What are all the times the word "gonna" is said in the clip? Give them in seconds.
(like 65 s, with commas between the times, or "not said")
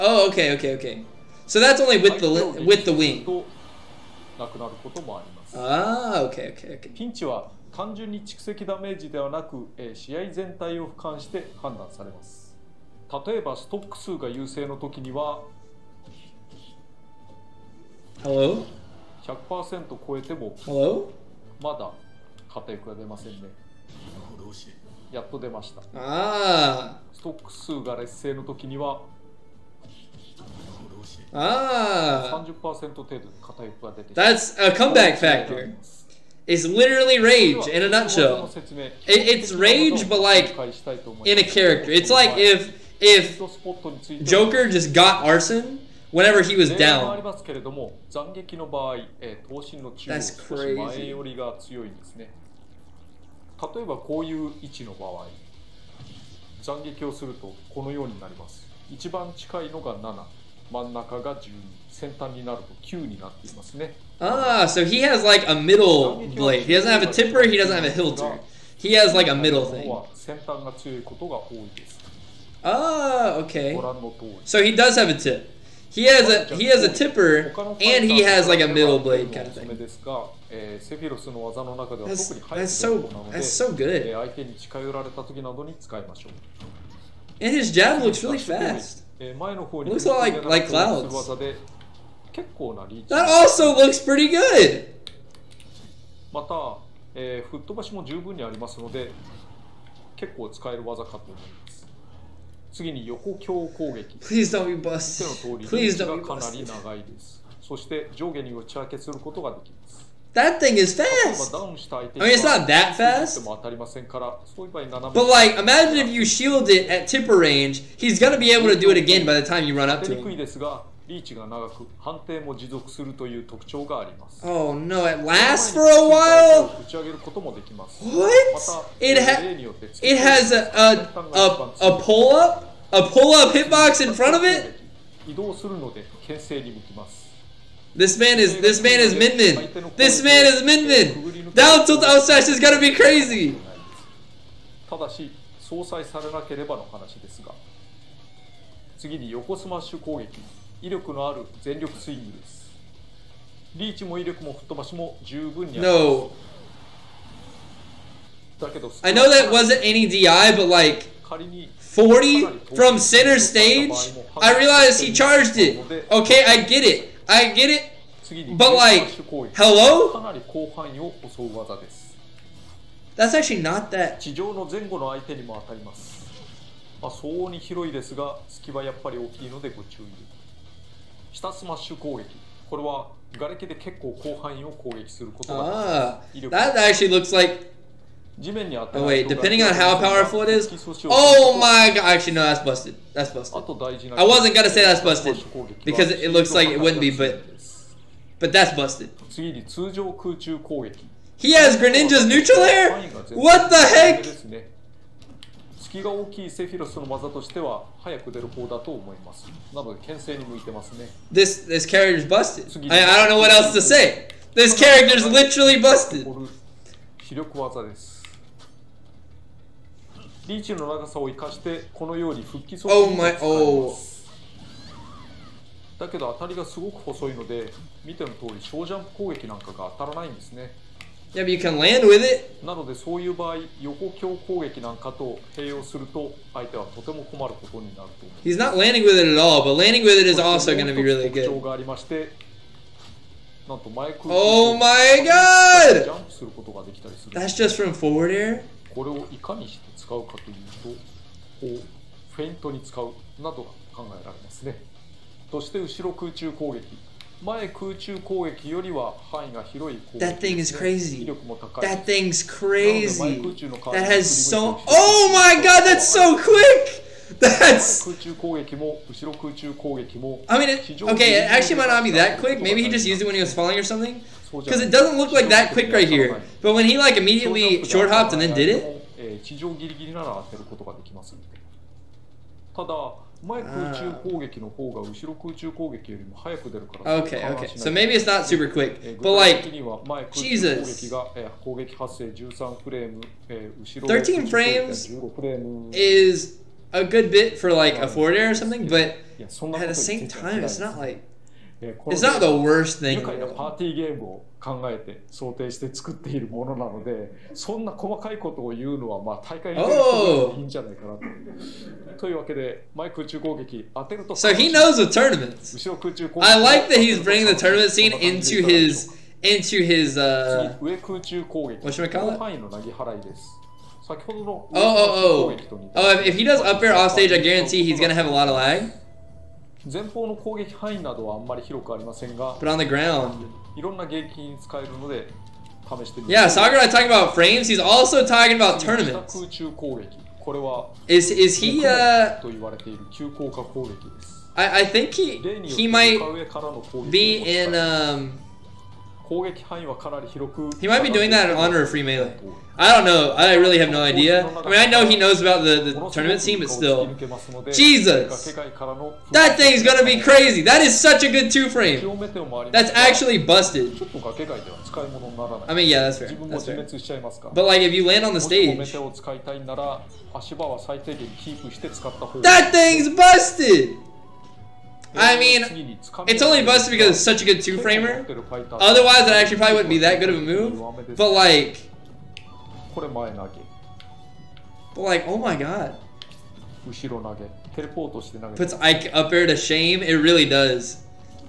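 118 s, 142 s, 194 s, 328 s, 359 s.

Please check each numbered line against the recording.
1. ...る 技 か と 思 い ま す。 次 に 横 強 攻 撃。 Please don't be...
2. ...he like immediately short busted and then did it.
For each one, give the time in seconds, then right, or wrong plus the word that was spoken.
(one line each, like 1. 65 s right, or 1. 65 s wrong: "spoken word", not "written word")
1. 100 s right
2. 276 s wrong: "hopped", not "busted".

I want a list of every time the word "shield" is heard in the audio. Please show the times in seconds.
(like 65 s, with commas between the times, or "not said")
116 s.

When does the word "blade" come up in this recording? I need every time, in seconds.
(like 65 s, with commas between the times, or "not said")
66 s, 78 s.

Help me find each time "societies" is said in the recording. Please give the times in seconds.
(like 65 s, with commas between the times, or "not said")
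not said.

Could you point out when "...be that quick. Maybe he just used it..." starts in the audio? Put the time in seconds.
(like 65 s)
272 s.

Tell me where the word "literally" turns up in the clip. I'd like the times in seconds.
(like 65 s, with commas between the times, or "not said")
36 s, 215 s.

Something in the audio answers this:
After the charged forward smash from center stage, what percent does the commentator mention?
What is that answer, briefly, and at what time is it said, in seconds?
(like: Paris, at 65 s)
40, at 162 s.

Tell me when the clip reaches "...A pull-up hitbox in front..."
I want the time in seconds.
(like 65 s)
132 s.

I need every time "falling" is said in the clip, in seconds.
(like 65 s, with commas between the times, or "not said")
273 s.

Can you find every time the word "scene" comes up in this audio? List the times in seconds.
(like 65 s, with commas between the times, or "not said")
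317 s, 356 s.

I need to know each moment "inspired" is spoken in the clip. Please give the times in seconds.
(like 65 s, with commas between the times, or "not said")
not said.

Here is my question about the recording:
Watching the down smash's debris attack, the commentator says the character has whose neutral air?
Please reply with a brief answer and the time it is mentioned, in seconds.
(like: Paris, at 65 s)
Greninja, at 201 s.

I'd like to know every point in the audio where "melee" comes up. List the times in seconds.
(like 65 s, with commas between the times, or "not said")
352 s.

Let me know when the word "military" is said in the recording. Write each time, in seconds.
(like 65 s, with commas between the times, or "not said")
not said.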